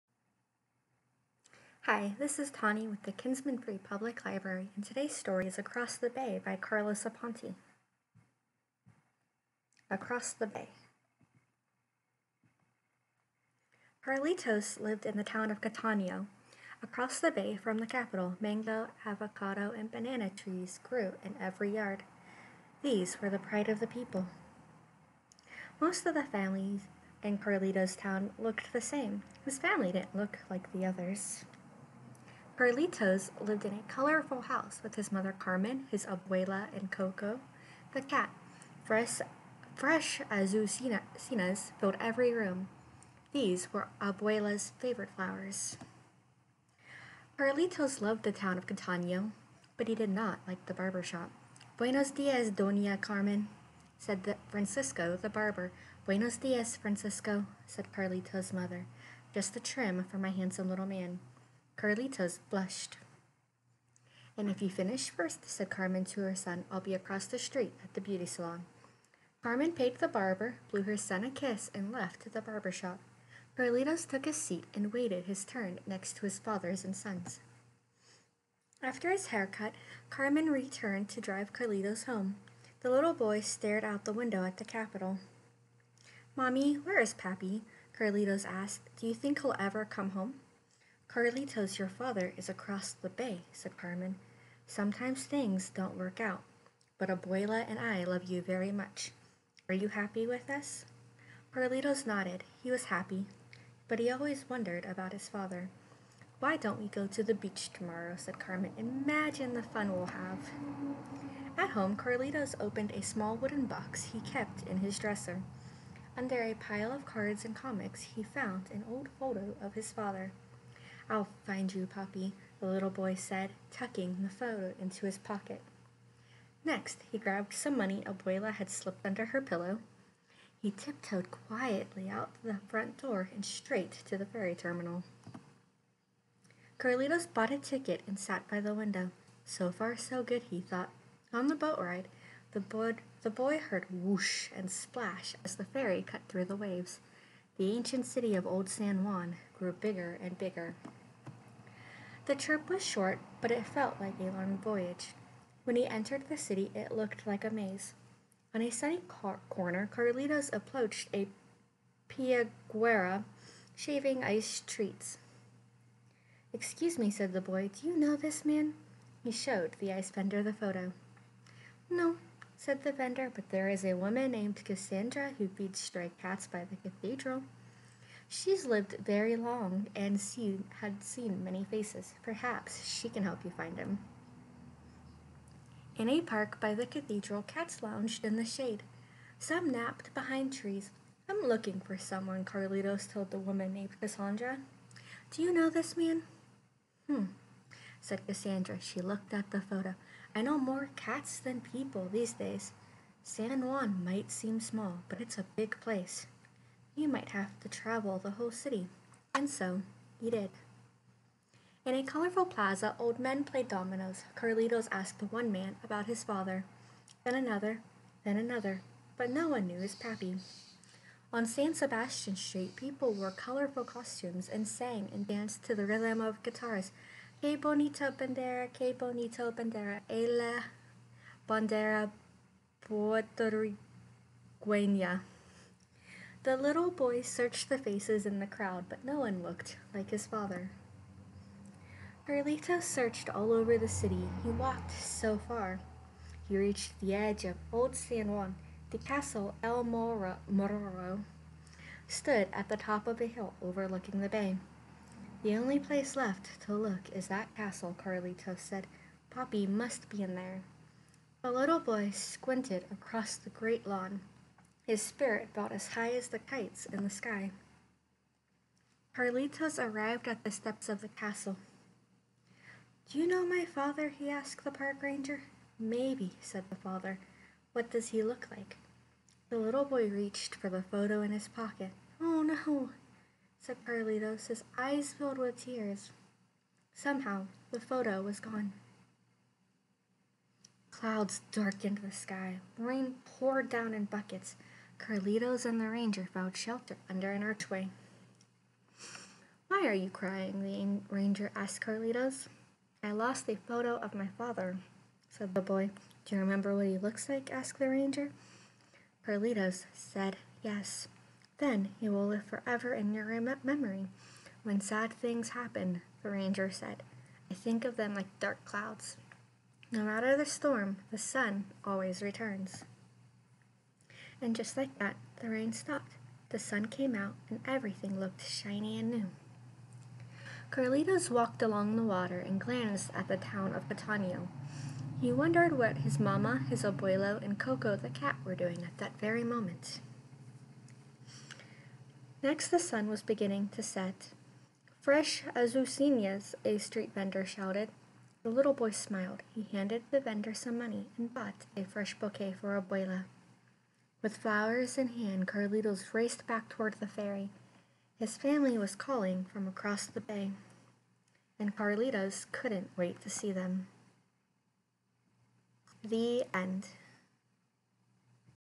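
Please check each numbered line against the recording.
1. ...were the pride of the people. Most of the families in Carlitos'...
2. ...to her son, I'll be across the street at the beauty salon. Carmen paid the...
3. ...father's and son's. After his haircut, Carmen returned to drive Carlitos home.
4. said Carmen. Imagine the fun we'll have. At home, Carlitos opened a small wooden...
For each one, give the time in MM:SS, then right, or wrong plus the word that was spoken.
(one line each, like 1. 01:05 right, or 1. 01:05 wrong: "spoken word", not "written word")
1. 00:23 right
2. 01:06 right
3. 01:16 right
4. 01:48 right.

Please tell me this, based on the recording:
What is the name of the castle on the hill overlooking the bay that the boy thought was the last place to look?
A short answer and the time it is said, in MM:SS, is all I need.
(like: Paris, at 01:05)
El Morro, at 04:09.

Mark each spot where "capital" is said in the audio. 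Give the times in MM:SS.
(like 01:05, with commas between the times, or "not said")
00:17, 01:24.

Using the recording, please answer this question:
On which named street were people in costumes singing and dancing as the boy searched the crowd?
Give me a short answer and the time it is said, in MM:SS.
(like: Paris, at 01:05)
San Sebastian Street, at 03:41.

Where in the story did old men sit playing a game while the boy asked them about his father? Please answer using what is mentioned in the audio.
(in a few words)
a colorful plaza.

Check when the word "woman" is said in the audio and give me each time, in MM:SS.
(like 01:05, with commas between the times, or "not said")
02:53, 03:13.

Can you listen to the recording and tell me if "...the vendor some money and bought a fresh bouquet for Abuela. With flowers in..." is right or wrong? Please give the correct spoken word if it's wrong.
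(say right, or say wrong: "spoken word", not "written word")
right.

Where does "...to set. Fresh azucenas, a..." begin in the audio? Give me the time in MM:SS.
05:43.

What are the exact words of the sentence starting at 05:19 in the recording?
No matter the storm, the sun always returns.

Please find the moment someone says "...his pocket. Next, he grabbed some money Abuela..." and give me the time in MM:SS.
02:05.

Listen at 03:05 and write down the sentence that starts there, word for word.
In a park by the cathedral, cats lounged in the shade.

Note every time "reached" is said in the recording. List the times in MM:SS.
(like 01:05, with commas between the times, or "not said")
04:06, 04:40.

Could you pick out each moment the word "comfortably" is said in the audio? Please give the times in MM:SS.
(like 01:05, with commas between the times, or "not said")
not said.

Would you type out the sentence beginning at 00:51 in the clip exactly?
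Buenos dias, Doña Carmen, said the Francisco, the barber.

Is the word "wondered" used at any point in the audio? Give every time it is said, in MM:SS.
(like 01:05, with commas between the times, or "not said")
01:44, 05:35.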